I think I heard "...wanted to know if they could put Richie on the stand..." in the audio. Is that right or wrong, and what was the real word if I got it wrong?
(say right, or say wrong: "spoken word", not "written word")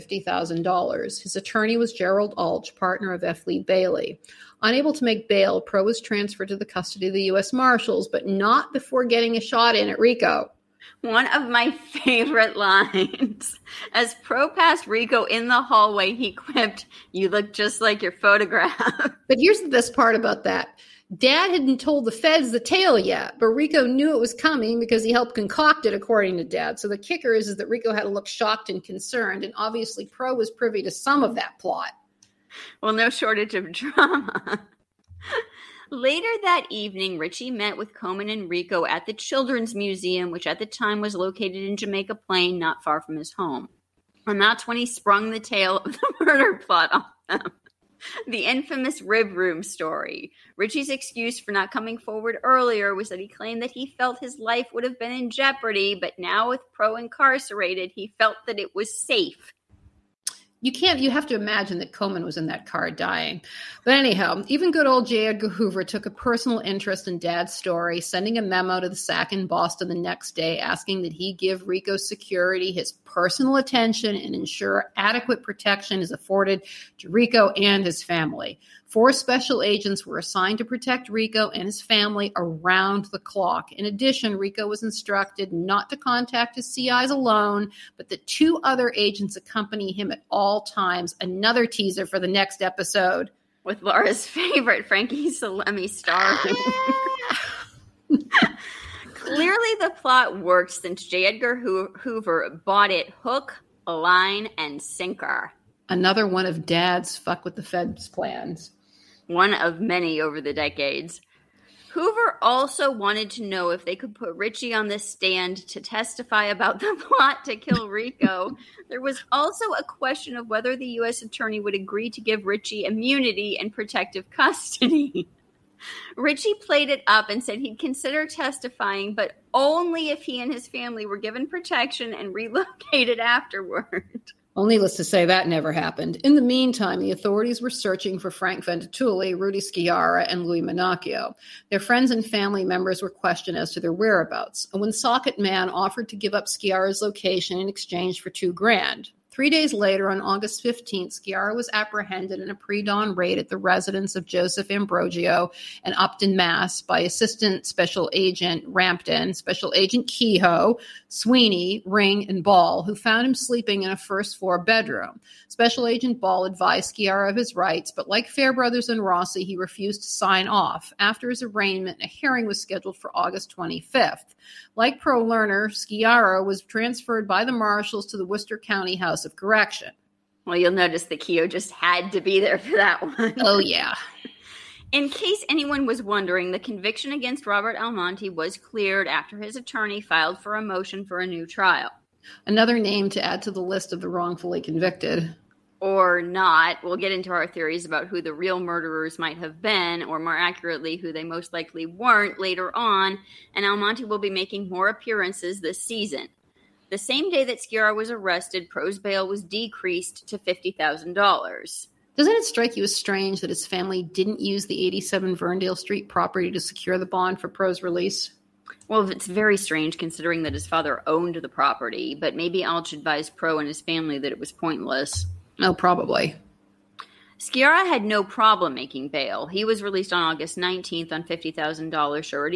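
right.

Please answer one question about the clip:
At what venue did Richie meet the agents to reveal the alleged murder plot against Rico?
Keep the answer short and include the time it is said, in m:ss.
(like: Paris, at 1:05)
the Children's Museum, at 0:39.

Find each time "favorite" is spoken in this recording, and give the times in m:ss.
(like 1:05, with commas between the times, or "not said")
0:11, 1:34.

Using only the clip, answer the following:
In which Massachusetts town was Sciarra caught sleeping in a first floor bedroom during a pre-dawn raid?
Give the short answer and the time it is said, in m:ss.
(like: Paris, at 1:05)
Upton, at 2:35.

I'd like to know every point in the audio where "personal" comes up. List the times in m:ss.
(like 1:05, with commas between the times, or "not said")
1:06, 1:13.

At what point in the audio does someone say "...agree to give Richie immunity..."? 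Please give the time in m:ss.
2:01.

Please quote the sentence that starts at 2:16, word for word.
In the meantime, the authorities were searching for Frank Ventatulli, Rudy Sciarra, and Louis Manocchio.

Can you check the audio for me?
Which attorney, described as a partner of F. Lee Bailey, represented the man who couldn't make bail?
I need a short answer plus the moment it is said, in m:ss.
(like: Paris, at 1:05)
Gerald Alch, at 0:01.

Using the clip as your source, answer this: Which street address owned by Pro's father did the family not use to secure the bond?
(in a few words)
87 Verndale Street.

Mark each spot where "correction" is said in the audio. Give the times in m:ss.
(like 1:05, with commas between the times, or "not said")
2:59.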